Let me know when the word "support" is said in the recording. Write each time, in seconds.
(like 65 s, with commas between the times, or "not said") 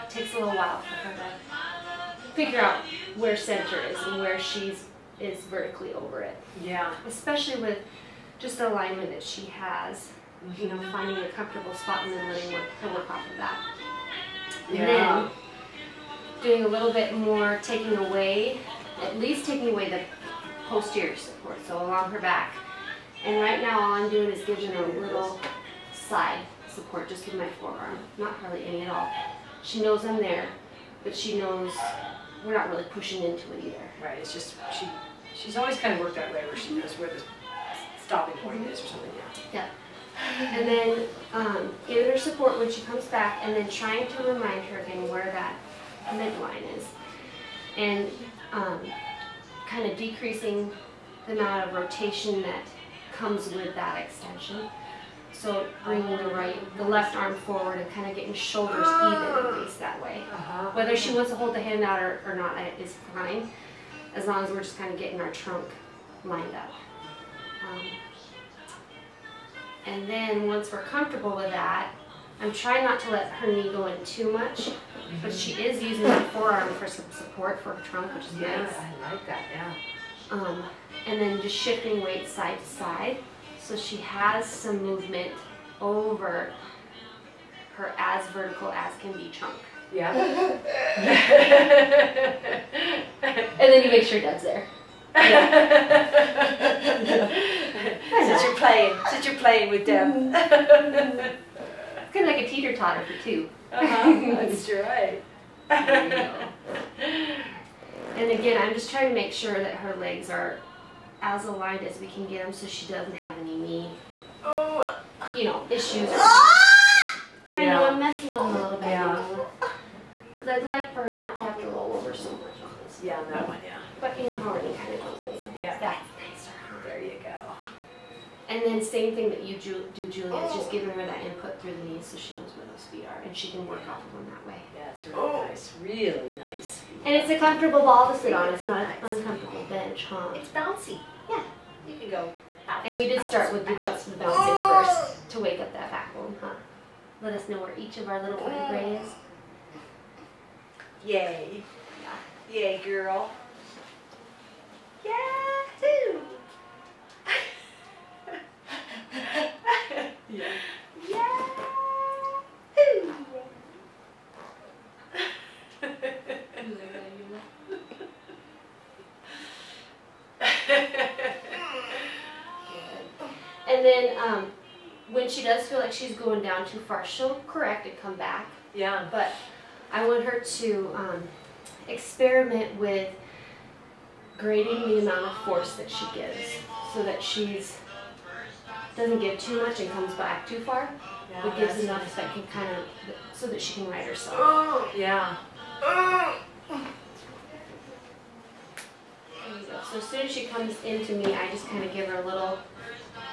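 21 s, 26 s, 42 s, 77 s.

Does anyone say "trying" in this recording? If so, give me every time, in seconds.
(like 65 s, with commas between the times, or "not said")
43 s, 72 s, 108 s.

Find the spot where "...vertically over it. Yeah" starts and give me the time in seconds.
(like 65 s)
5 s.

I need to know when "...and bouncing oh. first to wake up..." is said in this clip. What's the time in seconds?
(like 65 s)
144 s.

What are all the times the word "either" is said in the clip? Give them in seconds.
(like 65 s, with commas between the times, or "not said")
33 s.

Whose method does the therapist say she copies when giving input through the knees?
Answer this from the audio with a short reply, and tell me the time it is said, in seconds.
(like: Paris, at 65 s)
Julia, at 129 s.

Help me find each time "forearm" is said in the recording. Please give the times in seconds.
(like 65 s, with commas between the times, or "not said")
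27 s, 76 s.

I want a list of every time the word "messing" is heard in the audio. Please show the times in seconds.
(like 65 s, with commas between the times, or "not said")
117 s.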